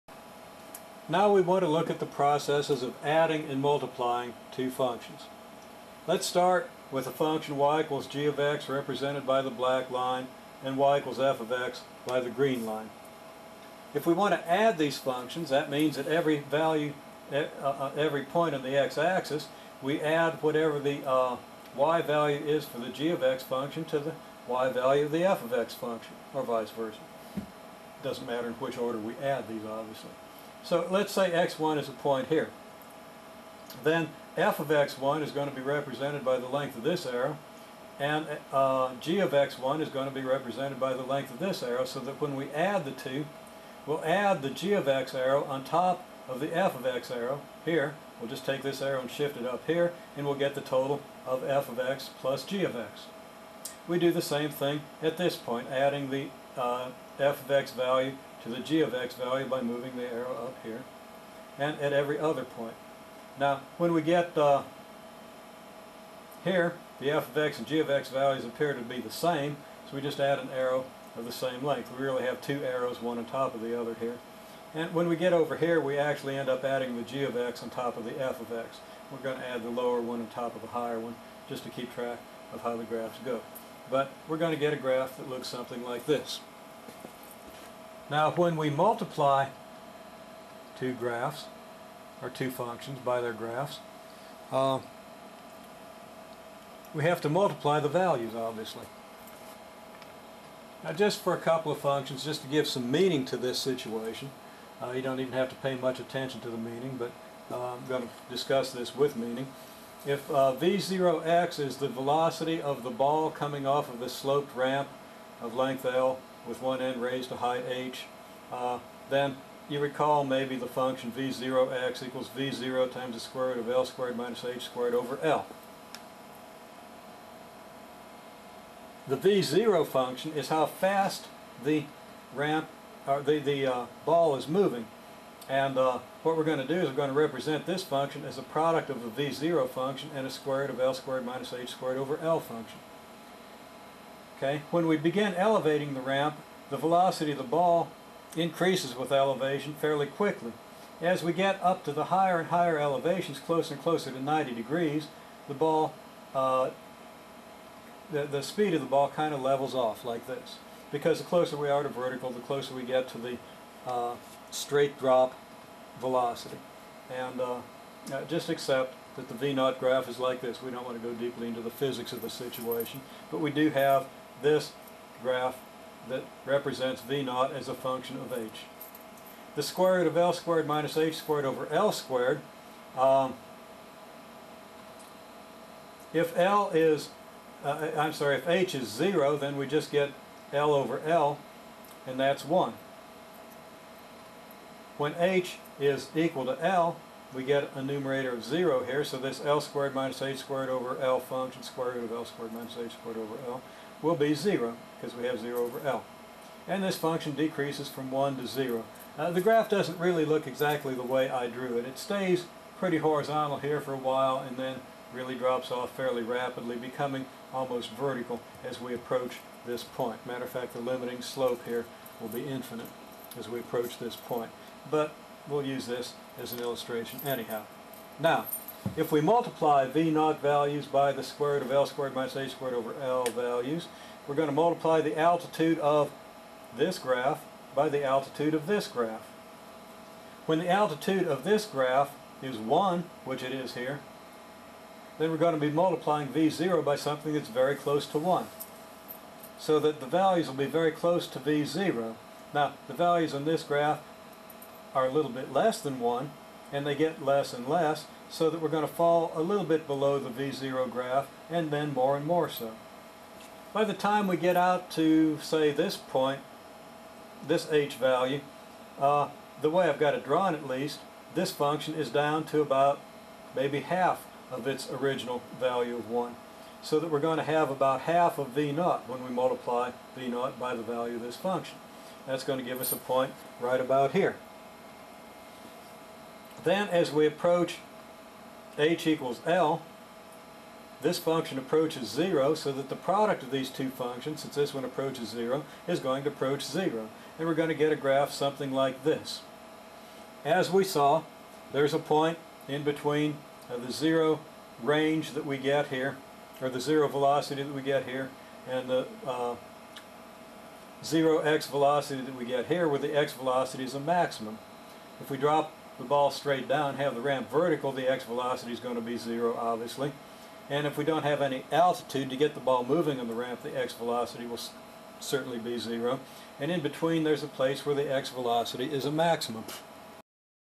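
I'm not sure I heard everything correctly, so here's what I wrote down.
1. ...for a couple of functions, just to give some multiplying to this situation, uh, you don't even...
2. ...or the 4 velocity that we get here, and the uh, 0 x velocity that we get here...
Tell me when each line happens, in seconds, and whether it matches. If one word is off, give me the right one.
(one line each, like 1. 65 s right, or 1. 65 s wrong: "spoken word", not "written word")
1. 101 s wrong: "meaning", not "multiplying"
2. 306 s wrong: "0", not "4".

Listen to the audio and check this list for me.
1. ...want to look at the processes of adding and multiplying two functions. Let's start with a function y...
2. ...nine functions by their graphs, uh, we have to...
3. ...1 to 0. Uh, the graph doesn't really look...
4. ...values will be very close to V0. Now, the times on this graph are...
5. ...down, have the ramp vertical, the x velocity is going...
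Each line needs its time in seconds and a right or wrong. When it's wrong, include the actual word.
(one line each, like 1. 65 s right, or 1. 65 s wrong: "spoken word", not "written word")
1. 1 s right
2. 92 s wrong: "two", not "nine"
3. 208 s right
4. 250 s wrong: "values", not "times"
5. 316 s right.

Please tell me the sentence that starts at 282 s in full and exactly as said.
That's going to give us a point right about here.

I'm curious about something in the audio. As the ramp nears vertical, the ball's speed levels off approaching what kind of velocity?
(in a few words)
straight drop velocity.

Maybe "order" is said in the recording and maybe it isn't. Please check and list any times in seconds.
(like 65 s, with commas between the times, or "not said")
28 s.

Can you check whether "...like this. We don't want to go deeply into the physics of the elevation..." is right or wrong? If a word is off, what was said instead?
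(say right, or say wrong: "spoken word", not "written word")
wrong: "situation", not "elevation".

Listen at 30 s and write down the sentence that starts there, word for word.
So let's say x1 is a point here.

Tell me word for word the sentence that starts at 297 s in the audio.
And we're going to get a graph something like this.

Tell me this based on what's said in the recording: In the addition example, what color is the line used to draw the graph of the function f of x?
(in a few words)
green.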